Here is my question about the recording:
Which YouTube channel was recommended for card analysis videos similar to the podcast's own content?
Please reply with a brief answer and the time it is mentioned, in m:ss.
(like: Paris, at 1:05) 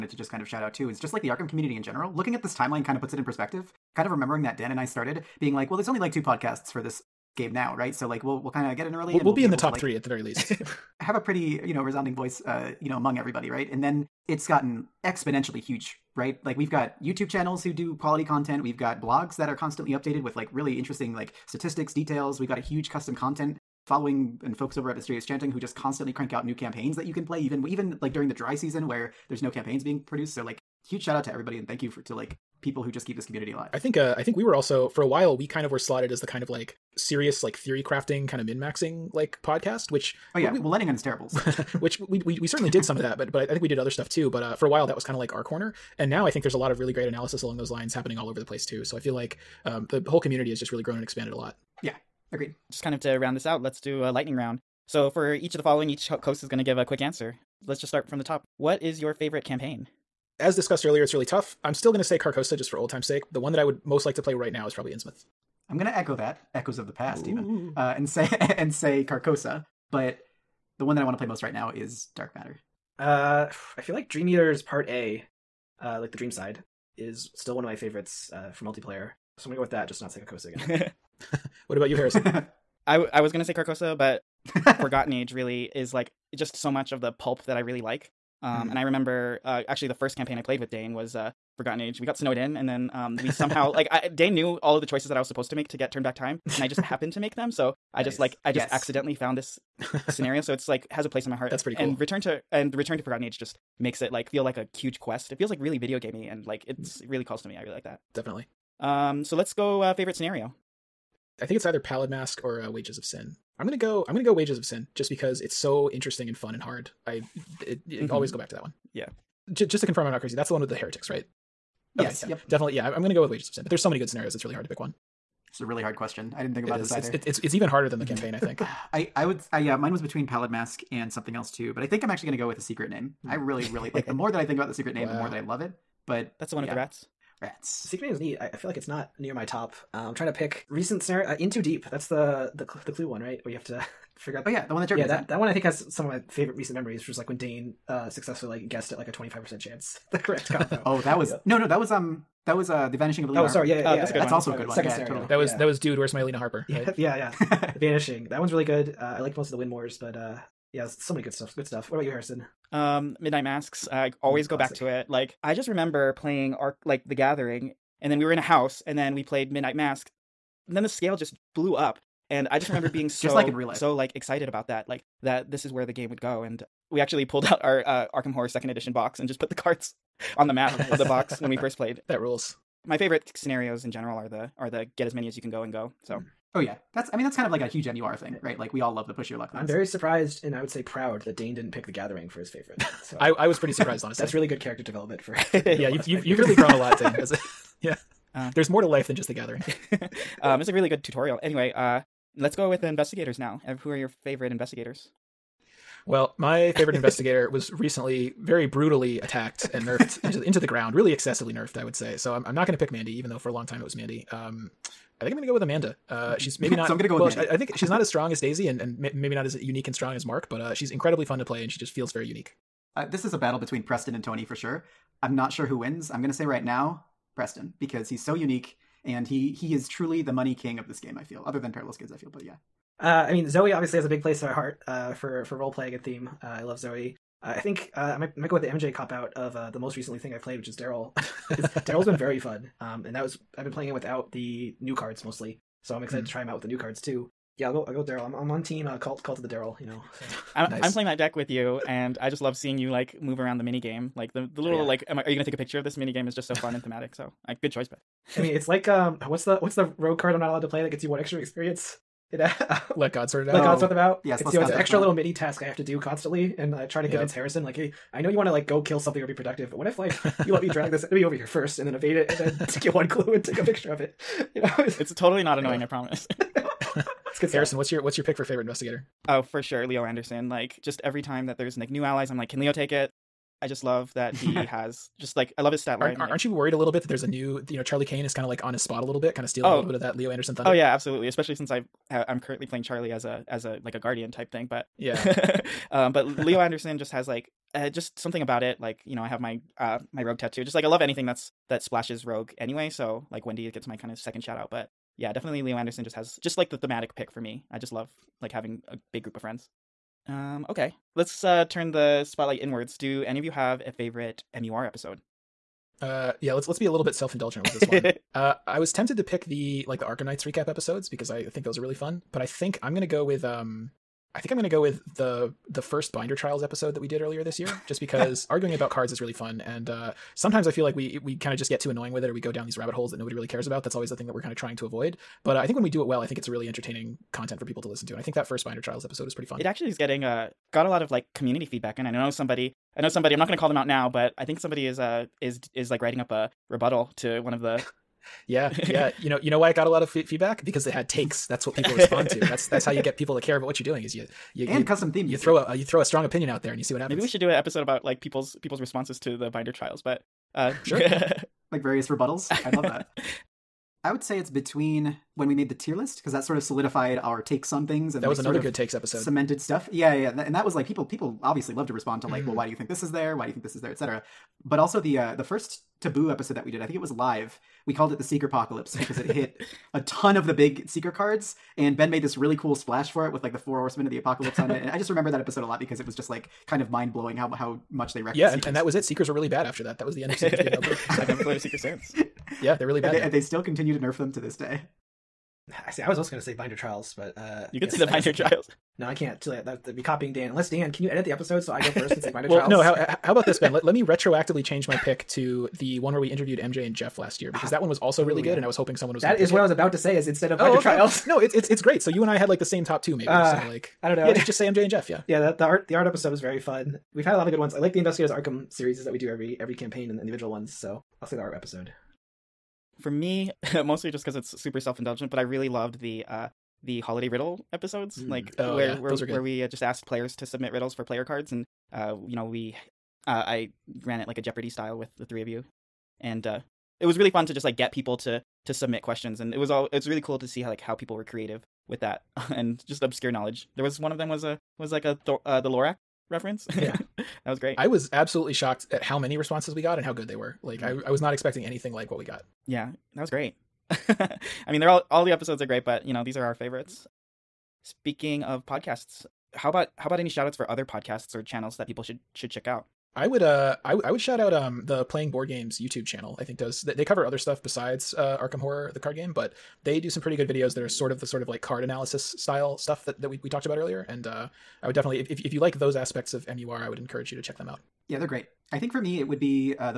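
Playing Board Games, at 7:45.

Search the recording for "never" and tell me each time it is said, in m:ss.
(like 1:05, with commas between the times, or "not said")
6:31.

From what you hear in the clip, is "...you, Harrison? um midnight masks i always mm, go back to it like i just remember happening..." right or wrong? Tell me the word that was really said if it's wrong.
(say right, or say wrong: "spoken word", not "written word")
wrong: "playing", not "happening".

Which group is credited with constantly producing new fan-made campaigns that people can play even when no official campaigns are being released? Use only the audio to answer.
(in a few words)
Mysterious Chanting.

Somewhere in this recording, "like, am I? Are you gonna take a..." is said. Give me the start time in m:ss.
4:14.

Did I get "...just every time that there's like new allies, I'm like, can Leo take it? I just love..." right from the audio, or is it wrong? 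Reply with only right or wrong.
right.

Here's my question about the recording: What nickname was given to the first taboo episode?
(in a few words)
Seeker Apocalypse.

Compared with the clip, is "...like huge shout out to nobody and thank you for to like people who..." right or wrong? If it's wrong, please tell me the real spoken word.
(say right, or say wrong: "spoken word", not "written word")
wrong: "everybody", not "nobody".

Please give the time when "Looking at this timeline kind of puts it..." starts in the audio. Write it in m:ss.
0:02.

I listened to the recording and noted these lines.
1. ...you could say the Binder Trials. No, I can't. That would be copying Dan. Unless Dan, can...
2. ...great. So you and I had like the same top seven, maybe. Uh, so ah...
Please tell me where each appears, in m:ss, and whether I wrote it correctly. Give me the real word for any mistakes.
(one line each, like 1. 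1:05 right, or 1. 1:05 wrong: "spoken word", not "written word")
1. 6:37 right
2. 6:51 wrong: "two", not "seven".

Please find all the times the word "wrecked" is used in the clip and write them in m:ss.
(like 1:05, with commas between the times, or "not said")
6:28.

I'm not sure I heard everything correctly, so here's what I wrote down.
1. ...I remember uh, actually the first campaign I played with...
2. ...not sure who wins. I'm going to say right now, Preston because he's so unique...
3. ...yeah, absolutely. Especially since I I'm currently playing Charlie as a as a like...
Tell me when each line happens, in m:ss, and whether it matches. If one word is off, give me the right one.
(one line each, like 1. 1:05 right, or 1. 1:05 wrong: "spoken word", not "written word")
1. 1:28 right
2. 3:45 right
3. 4:50 right.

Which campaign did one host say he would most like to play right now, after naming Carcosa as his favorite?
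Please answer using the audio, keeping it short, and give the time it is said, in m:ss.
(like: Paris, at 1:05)
Innsmouth, at 1:04.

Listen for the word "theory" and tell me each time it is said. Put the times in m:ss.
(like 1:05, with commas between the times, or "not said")
0:37.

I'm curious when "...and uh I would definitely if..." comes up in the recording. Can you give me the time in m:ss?
7:54.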